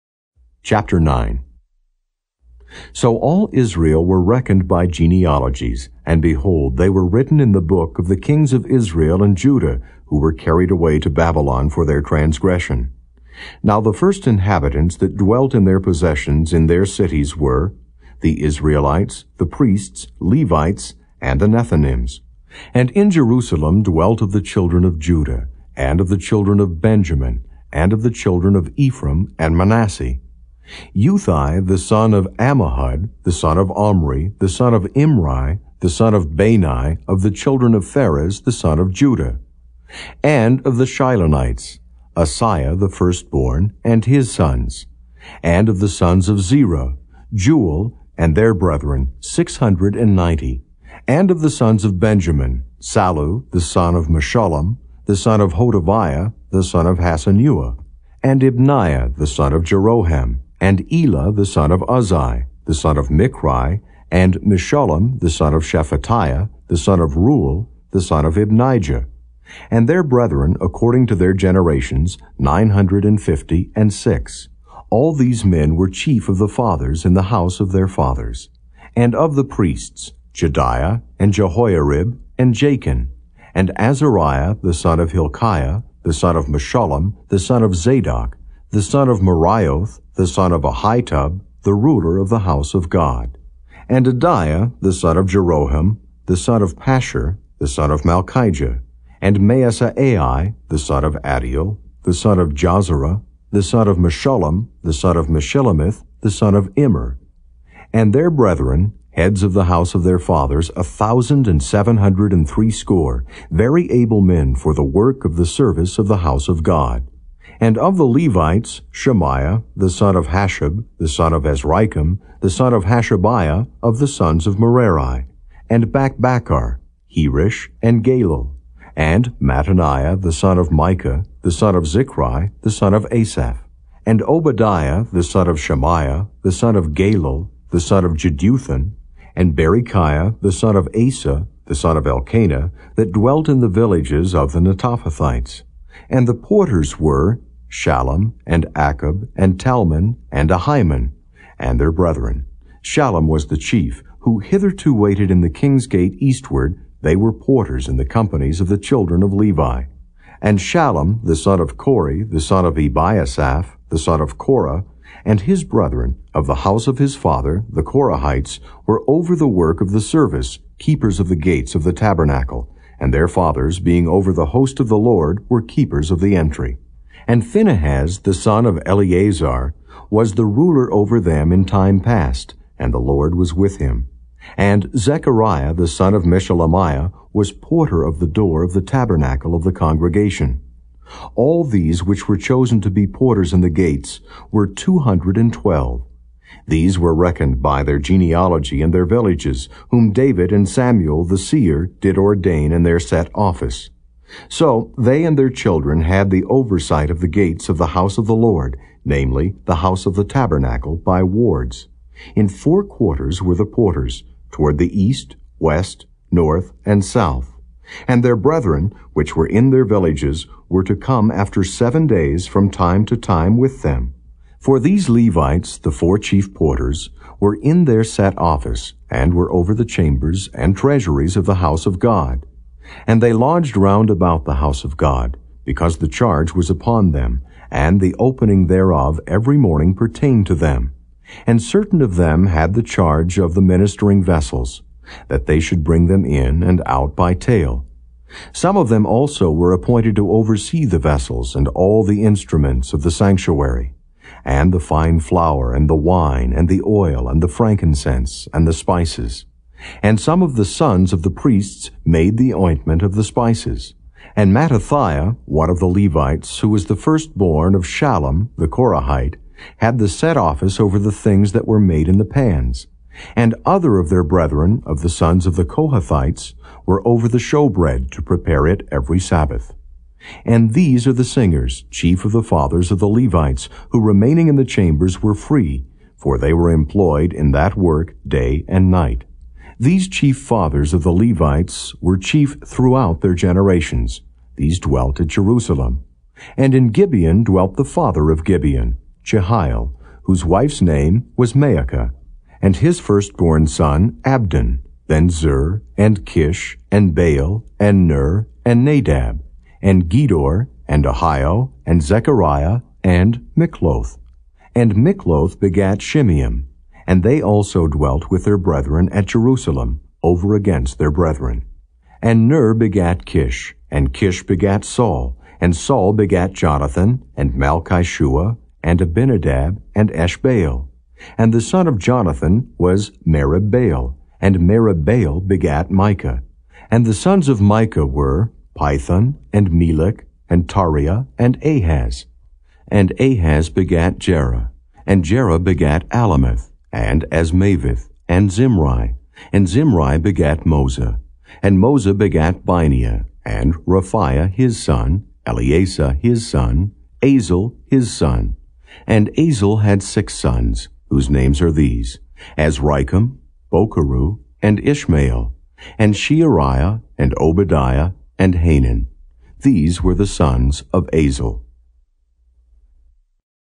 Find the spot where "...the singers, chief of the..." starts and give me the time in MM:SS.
04:41.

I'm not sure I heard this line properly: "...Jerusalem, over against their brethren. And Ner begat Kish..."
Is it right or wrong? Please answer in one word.
right.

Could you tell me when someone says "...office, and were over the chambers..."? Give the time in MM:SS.
03:48.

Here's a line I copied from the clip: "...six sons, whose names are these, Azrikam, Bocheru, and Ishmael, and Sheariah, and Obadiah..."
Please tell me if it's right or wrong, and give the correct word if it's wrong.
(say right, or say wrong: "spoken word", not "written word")
right.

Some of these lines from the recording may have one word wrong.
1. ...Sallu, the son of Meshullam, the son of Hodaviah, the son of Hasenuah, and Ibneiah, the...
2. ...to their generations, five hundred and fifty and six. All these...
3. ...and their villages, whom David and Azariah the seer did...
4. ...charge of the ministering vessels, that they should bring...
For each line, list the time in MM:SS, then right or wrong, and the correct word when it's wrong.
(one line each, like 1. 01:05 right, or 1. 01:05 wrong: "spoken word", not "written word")
1. 00:52 right
2. 01:11 wrong: "nine", not "five"
3. 03:18 wrong: "Samuel", not "Azariah"
4. 04:02 right.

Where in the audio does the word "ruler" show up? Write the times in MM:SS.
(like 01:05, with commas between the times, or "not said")
01:31, 03:00.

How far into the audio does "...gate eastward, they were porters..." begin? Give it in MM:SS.
02:35.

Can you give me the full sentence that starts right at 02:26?
And the porters were Shallum, and Achab, and Talmon, and Ahiman, and their brethren.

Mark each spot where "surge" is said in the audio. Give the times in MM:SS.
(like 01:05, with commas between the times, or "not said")
not said.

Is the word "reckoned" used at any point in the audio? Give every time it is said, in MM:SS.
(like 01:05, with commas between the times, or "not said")
00:04, 03:17.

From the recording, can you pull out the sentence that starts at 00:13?
Now the first inhabitants that dwelt in their possessions in their cities were the Israelites, the priests, Levites, and the Nethinims.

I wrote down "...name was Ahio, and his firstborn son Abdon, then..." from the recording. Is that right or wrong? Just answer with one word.
wrong.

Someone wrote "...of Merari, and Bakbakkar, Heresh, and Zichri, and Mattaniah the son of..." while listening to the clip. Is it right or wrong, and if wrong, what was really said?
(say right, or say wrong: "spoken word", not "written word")
wrong: "Galal", not "Zichri".